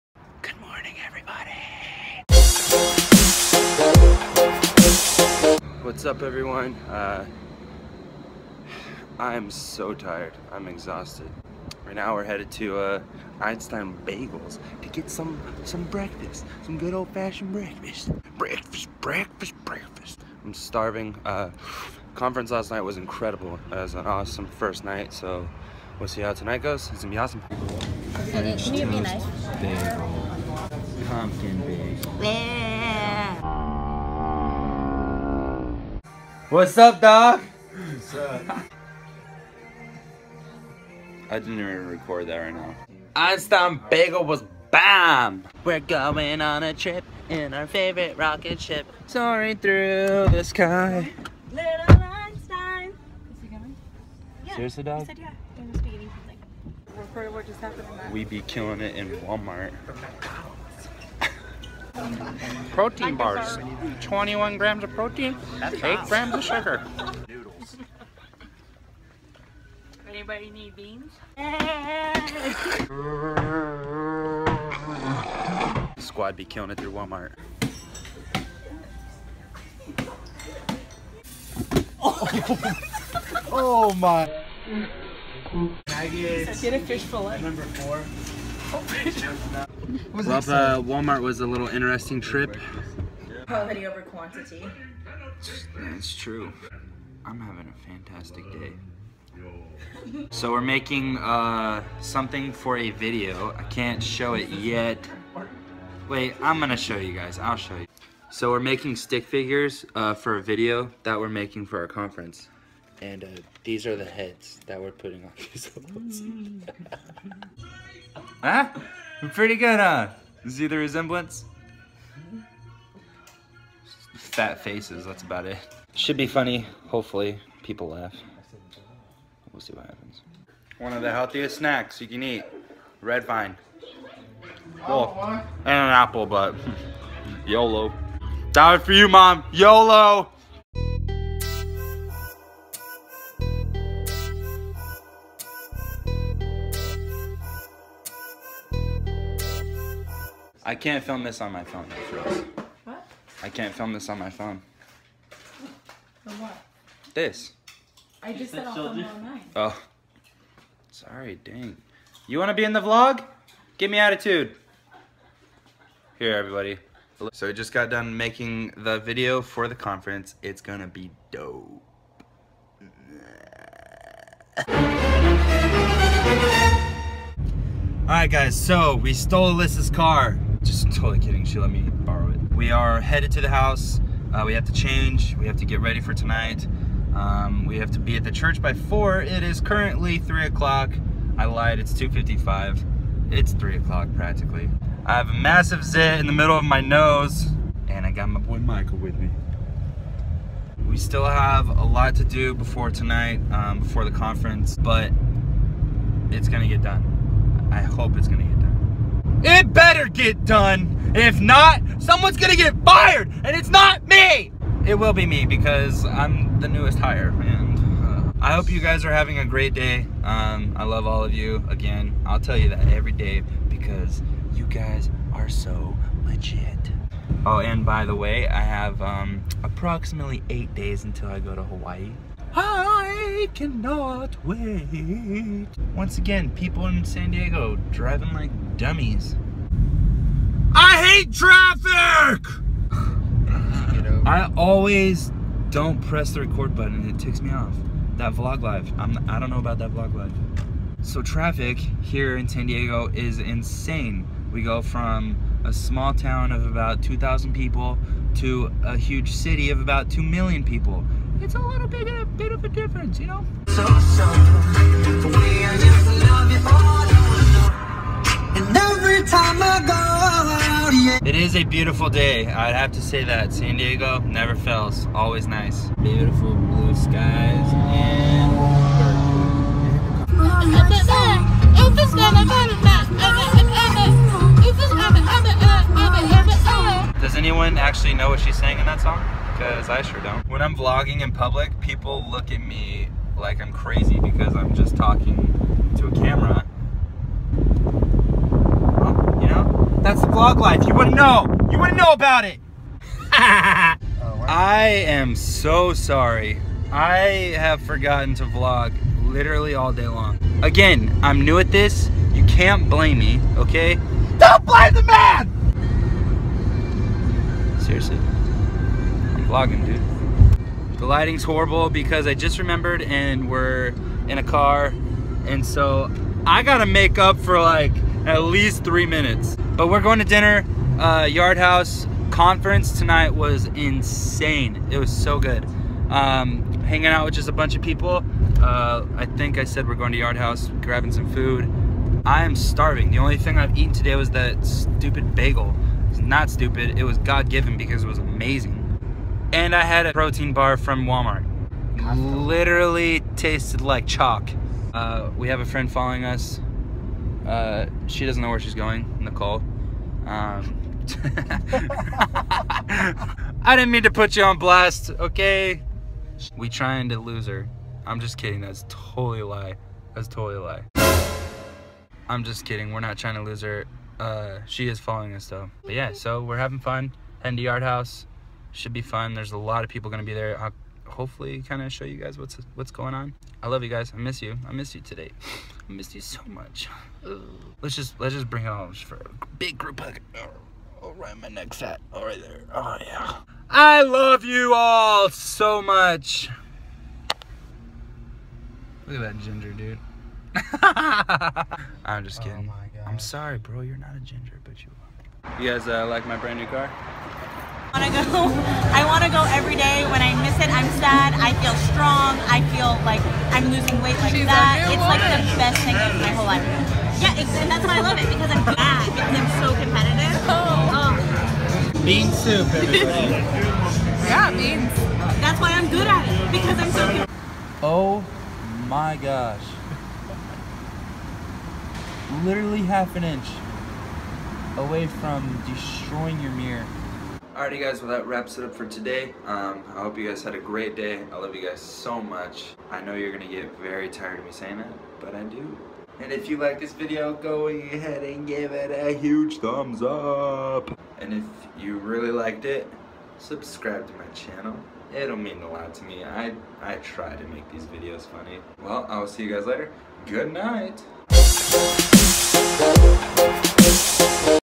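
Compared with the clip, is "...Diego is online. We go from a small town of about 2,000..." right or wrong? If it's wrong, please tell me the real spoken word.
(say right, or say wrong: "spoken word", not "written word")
wrong: "insane", not "online".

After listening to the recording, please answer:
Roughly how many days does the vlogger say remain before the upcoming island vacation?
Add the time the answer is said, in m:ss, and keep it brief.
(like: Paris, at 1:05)
8, at 3:50.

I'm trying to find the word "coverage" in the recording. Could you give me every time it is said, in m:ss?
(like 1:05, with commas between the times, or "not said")
not said.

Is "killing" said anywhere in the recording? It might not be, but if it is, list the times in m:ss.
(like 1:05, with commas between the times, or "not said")
0:58, 1:16.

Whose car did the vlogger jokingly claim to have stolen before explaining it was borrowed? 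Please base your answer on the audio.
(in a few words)
Alyssa's.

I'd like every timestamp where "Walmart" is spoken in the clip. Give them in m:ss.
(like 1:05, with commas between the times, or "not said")
0:59, 1:16, 1:30, 5:51.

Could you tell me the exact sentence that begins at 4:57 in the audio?
Well, you know, that's the vlog life.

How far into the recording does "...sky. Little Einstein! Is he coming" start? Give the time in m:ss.
0:50.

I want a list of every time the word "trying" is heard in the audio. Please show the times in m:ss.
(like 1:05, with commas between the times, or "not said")
6:06, 6:13.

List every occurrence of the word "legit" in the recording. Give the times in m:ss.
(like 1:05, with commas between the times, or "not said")
3:46.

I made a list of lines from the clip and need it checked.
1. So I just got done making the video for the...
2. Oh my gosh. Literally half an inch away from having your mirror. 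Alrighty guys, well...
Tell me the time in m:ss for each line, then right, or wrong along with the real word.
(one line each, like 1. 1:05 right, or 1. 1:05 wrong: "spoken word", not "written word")
1. 2:47 right
2. 7:07 wrong: "destroying", not "having".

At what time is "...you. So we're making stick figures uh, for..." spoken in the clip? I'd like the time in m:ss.
1:47.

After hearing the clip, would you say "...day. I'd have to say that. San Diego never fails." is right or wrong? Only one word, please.
right.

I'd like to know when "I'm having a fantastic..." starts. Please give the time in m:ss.
1:37.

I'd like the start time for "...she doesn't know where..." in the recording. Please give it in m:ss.
5:58.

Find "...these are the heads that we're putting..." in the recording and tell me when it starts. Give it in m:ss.
1:53.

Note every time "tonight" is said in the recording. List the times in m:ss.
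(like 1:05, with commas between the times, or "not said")
0:26, 3:06, 3:22, 5:32.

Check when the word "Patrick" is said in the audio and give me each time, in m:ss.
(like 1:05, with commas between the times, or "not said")
not said.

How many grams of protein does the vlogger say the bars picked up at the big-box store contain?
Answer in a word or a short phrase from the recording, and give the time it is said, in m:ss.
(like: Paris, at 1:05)
21, at 1:04.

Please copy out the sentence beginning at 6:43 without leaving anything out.
You're not a ginger, but you are.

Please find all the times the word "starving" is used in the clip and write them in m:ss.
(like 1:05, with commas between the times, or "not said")
0:20, 5:42.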